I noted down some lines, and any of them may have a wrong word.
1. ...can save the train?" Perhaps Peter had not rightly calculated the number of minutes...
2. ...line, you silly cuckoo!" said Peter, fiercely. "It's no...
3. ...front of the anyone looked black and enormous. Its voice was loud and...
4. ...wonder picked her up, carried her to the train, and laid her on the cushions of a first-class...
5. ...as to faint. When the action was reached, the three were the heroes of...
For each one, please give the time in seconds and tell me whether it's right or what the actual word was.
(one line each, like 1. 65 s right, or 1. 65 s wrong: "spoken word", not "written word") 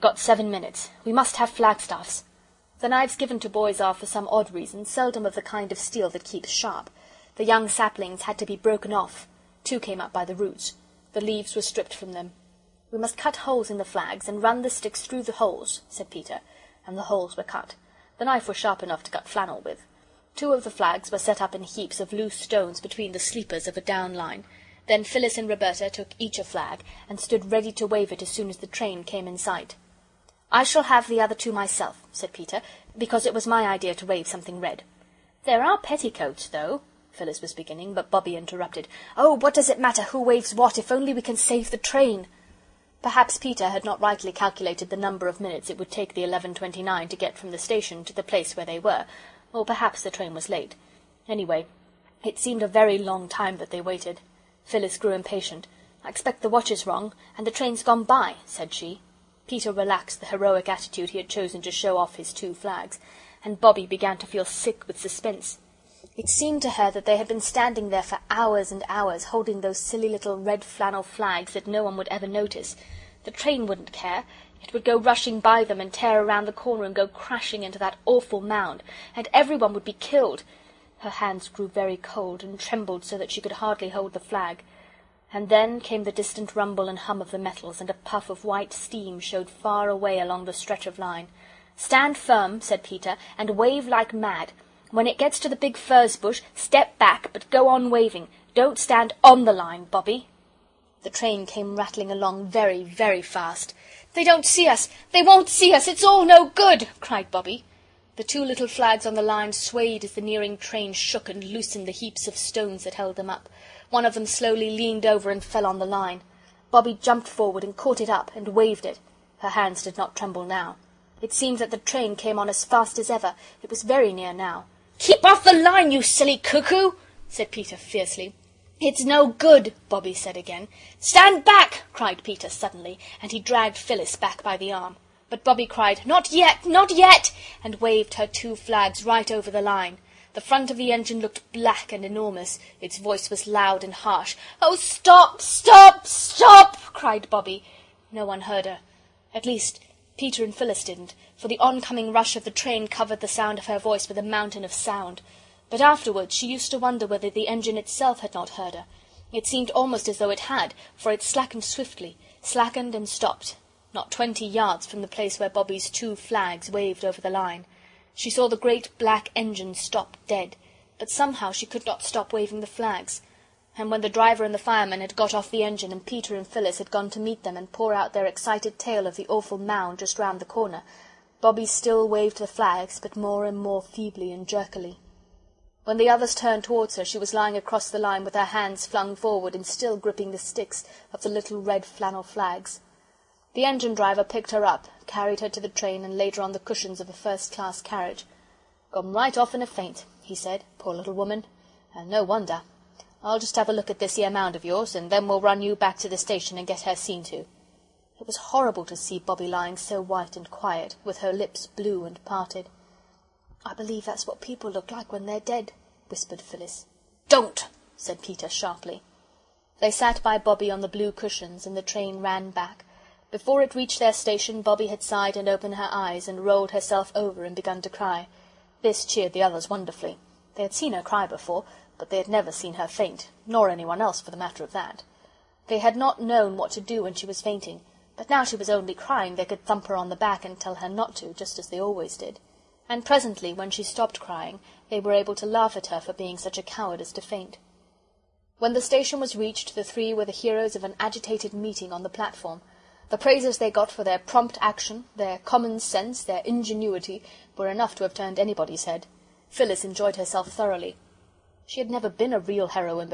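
1. 41 s right
2. 125 s right
3. 140 s wrong: "engine", not "anyone"
4. 193 s wrong: "driver", not "wonder"
5. 247 s wrong: "station", not "action".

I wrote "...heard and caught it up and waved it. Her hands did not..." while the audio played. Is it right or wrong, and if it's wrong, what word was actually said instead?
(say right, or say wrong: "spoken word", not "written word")
wrong: "forward", not "heard".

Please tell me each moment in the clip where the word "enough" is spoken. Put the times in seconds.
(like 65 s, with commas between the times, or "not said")
18 s, 257 s.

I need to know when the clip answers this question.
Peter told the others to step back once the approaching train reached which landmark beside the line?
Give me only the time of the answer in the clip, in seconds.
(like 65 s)
95 s.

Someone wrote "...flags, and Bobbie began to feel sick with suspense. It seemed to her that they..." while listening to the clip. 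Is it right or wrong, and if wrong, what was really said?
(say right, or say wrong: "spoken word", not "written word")
right.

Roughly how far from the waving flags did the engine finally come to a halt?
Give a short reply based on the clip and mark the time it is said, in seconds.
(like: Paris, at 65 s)
20 yards, at 164 s.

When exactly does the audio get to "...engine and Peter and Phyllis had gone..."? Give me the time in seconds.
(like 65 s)
175 s.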